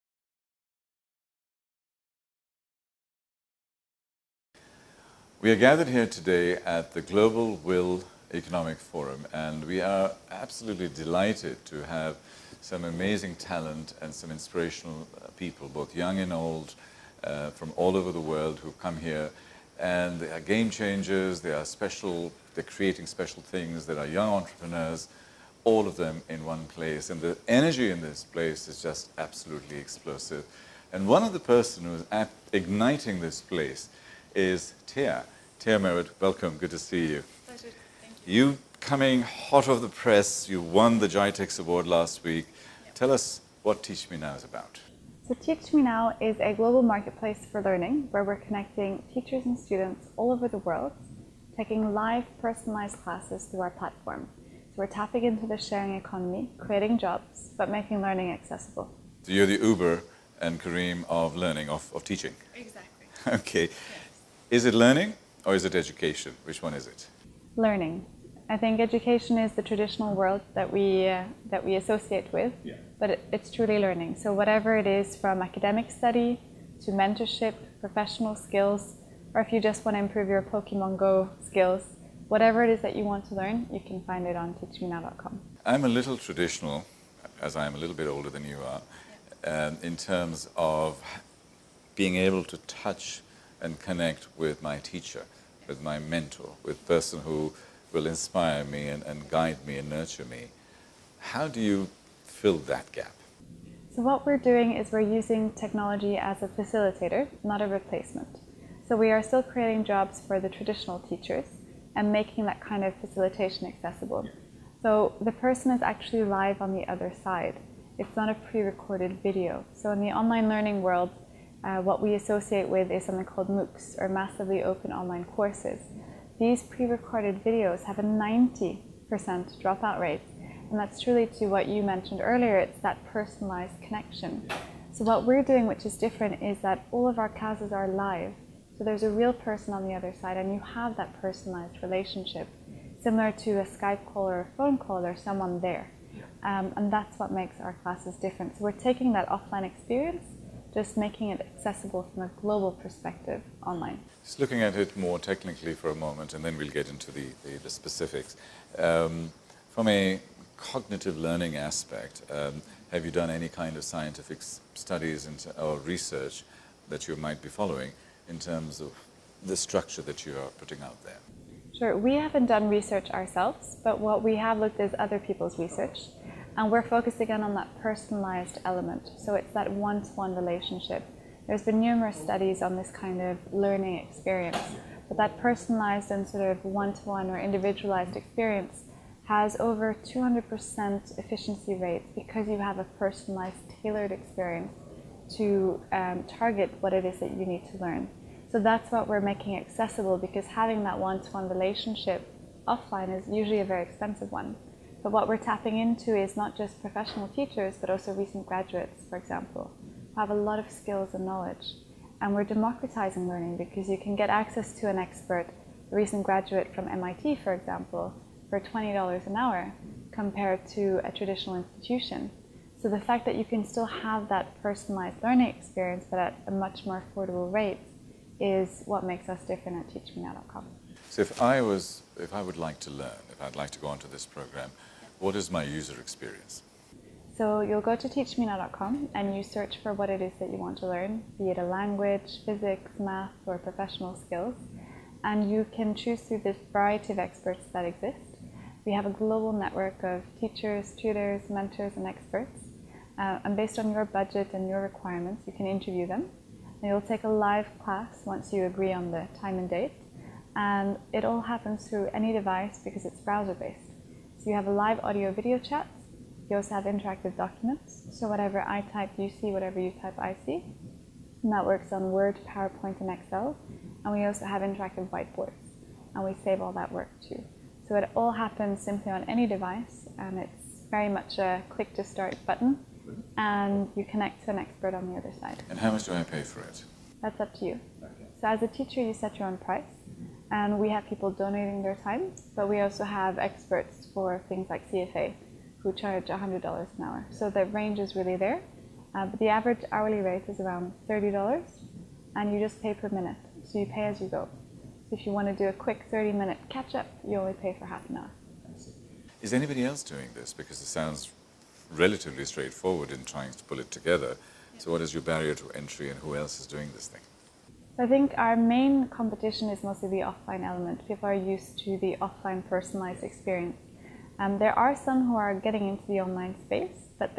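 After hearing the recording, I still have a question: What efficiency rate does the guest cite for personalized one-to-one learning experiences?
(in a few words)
over 200%.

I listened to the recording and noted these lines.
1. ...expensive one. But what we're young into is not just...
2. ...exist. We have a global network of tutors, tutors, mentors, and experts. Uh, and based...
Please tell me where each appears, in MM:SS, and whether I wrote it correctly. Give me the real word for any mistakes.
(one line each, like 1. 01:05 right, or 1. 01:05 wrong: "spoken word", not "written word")
1. 03:23 wrong: "tapping", not "young"
2. 04:07 wrong: "teachers", not "tutors".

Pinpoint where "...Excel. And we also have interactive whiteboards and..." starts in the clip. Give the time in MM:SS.
04:33.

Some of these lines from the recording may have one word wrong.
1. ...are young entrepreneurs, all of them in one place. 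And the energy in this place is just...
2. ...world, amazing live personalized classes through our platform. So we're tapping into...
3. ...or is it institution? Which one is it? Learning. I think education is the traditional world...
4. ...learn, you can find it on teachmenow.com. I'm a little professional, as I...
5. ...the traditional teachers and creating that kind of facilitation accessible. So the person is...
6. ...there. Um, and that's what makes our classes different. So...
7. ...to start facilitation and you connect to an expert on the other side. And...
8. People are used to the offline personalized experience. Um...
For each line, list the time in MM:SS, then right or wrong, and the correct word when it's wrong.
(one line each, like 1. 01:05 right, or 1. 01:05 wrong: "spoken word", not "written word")
1. 00:23 right
2. 00:50 wrong: "taking", not "amazing"
3. 01:05 wrong: "education", not "institution"
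4. 01:23 wrong: "traditional", not "professional"
5. 01:50 wrong: "making", not "creating"
6. 02:25 right
7. 04:41 wrong: "button", not "facilitation"
8. 05:21 right.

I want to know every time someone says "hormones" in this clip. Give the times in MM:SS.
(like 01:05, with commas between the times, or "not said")
not said.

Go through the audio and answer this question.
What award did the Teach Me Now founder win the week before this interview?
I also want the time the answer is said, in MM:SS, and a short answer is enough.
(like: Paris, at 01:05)
GITEX award, at 00:41.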